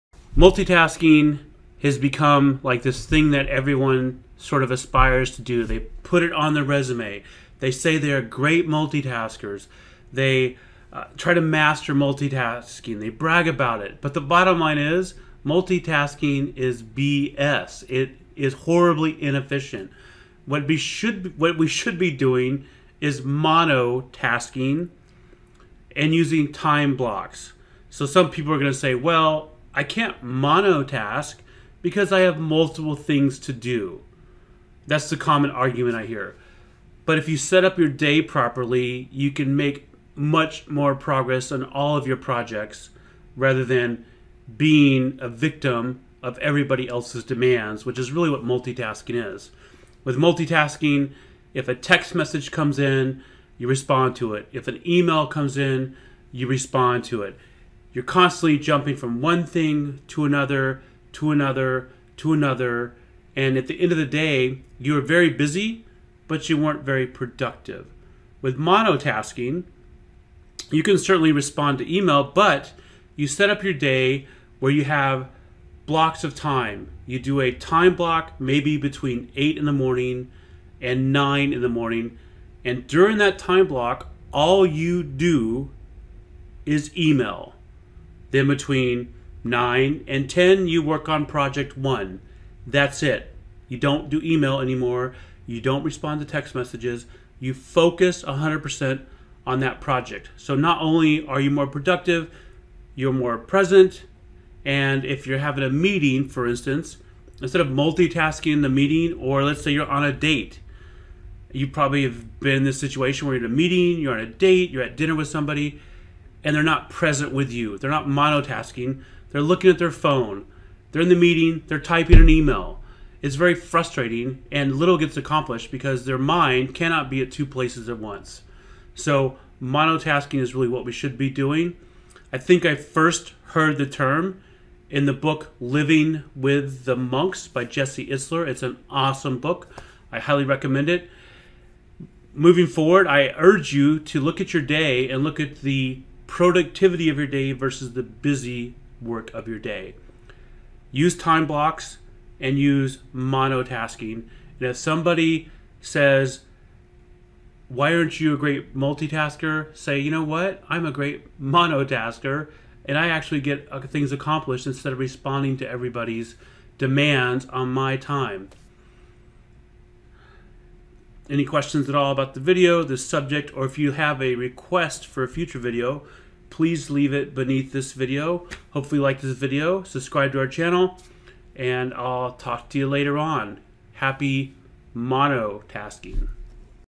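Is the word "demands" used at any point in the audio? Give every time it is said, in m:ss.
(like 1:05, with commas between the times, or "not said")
0:47, 2:46.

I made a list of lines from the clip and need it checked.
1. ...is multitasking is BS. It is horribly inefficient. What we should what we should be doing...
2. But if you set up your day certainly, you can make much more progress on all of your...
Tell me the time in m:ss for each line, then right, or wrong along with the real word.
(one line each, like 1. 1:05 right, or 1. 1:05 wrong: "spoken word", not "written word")
1. 0:14 right
2. 0:37 wrong: "properly", not "certainly".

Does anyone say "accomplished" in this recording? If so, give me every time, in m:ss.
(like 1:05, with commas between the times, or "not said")
2:05, 2:44.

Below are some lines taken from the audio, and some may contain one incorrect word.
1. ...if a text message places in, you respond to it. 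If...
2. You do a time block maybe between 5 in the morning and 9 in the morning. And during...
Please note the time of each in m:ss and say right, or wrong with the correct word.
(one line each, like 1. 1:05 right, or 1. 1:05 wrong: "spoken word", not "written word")
1. 0:51 wrong: "comes", not "places"
2. 1:17 wrong: "8", not "5".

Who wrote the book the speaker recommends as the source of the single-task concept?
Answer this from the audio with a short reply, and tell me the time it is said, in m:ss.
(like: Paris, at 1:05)
Jesse Itzler, at 2:17.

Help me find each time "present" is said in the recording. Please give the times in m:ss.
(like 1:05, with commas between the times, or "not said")
1:43, 1:56.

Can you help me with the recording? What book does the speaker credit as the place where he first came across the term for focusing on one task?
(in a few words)
Living with the Monks.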